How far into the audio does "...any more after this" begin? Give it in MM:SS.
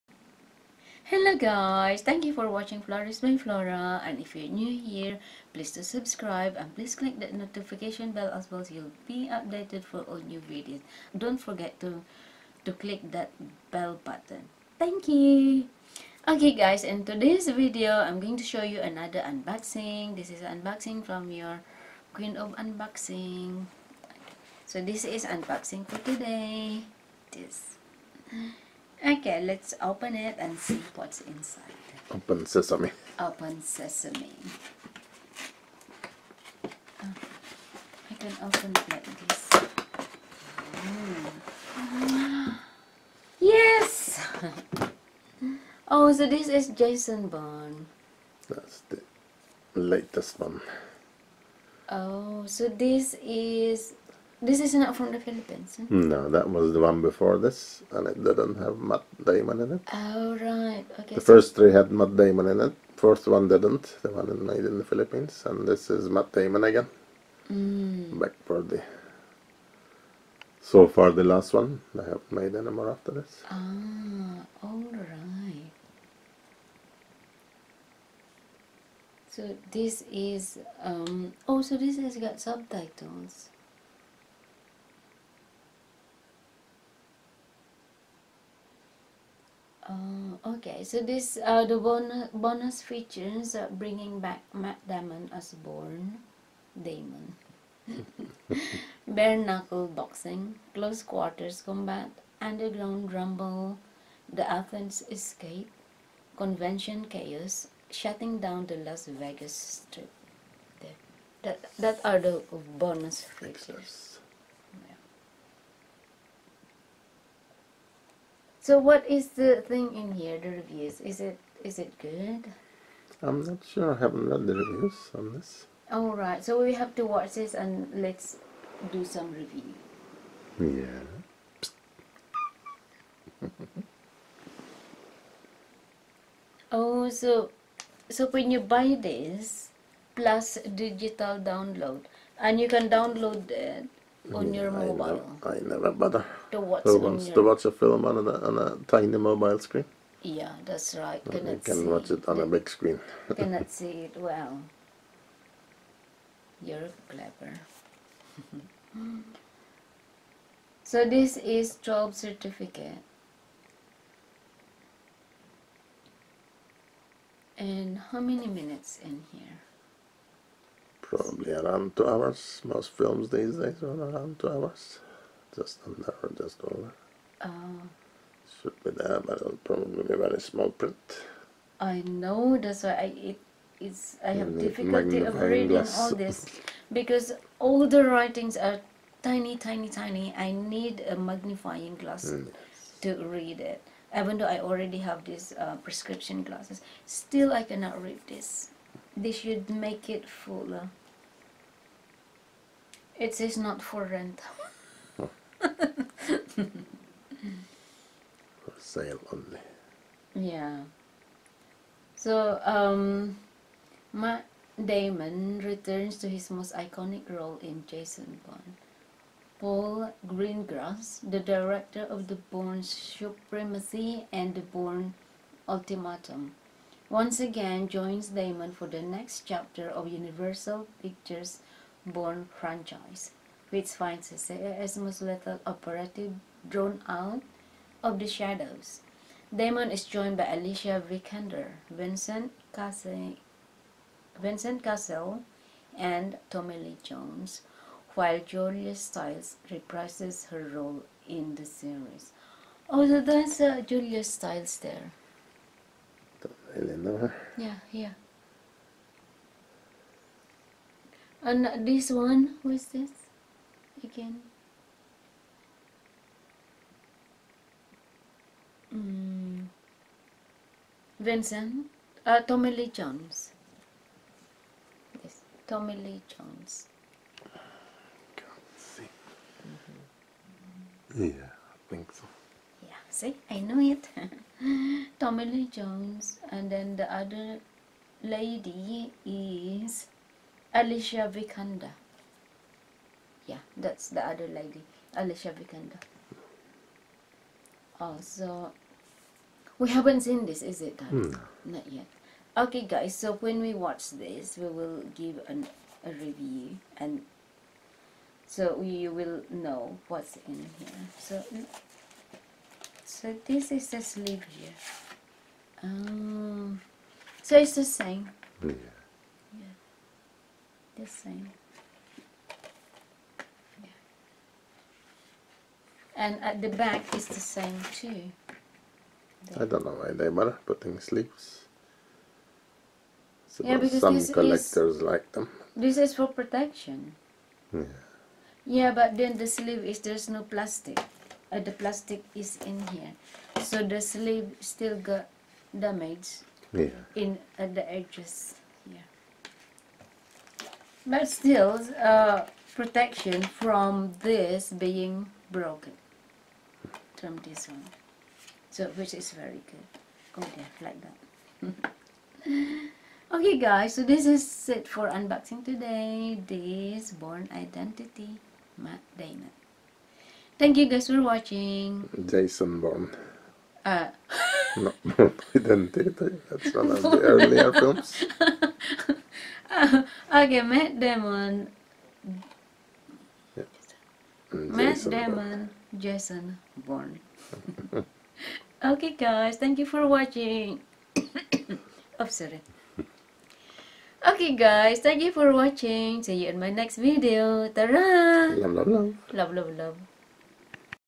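01:12.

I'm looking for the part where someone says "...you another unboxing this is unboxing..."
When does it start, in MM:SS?
00:18.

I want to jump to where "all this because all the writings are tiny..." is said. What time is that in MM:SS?
03:05.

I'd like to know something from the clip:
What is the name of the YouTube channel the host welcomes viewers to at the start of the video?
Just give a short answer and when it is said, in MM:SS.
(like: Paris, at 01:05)
Flourish by Flora, at 00:02.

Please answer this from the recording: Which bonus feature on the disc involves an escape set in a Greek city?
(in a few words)
The Athens escape.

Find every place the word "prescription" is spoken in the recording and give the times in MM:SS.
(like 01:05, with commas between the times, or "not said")
03:15.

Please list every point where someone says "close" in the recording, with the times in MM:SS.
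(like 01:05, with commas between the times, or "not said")
01:40.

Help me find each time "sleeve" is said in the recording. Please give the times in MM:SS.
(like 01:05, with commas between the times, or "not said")
05:14, 05:30, 05:39, 05:43.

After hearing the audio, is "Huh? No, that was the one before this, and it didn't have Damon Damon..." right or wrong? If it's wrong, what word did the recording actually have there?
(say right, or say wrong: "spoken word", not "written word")
wrong: "Matt", not "Damon".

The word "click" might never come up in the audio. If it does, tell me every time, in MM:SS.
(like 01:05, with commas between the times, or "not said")
00:06, 00:12.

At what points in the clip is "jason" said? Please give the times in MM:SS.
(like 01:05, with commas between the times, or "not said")
00:46, 03:37, 06:12, 06:25.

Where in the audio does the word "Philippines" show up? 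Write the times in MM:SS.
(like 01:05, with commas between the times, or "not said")
00:55, 01:04.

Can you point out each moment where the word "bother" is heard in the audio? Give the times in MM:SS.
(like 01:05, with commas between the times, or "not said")
02:25, 05:30.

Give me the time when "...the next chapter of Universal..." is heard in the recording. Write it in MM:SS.
03:48.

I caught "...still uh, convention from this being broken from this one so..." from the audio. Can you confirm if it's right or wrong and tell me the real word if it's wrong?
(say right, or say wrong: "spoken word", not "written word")
wrong: "protection", not "convention".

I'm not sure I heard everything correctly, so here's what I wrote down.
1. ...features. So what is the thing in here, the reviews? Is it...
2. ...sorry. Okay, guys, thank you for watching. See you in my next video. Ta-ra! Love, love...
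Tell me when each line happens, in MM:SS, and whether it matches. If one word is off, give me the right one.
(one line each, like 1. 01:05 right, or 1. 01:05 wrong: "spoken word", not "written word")
1. 01:53 right
2. 06:32 right.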